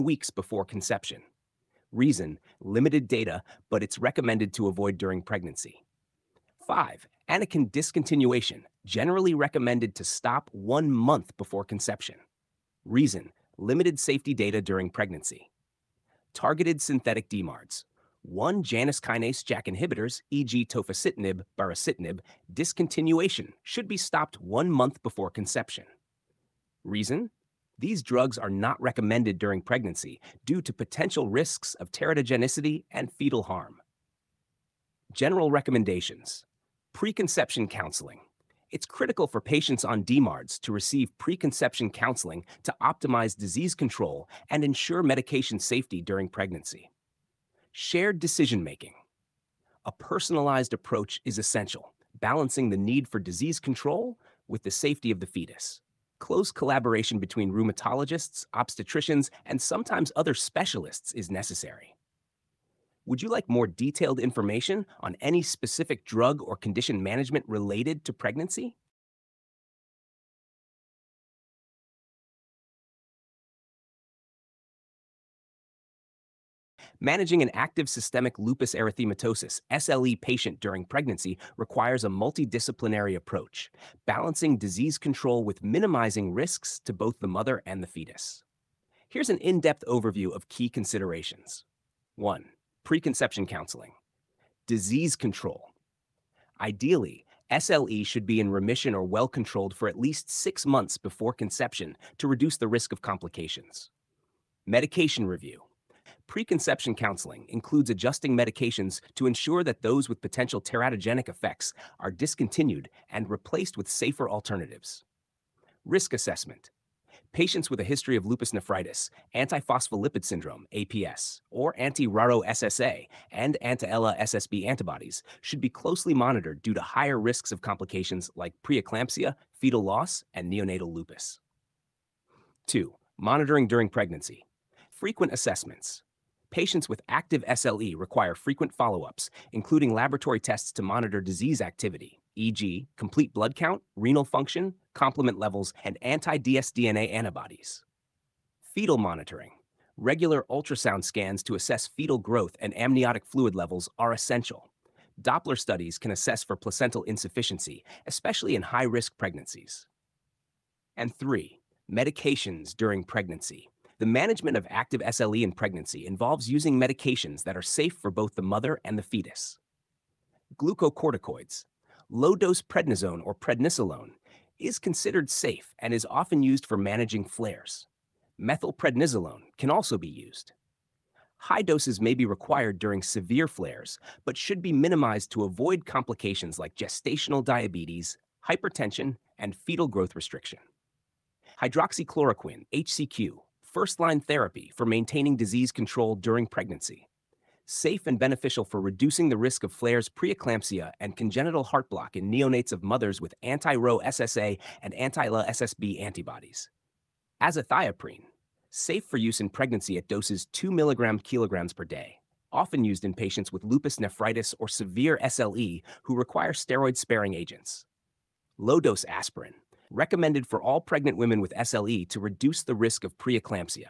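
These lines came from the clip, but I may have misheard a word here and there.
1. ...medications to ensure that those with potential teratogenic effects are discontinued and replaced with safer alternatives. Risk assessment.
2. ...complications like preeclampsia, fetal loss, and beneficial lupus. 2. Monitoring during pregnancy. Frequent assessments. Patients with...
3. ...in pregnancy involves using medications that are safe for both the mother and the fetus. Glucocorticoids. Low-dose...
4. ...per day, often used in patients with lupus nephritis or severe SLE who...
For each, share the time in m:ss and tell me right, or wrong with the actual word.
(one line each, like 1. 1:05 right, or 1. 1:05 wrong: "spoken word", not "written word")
1. 1:48 right
2. 2:07 wrong: "neonatal", not "beneficial"
3. 2:45 right
4. 3:31 right.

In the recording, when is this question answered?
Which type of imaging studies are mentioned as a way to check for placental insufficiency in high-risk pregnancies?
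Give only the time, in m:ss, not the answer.
2:35.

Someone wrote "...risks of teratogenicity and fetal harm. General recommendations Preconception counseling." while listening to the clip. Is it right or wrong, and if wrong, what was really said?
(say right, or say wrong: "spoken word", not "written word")
right.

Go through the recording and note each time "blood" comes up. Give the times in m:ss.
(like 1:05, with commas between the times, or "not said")
2:23.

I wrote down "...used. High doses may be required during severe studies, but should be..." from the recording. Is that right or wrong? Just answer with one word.
wrong.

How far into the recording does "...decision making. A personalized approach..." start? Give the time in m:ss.
0:48.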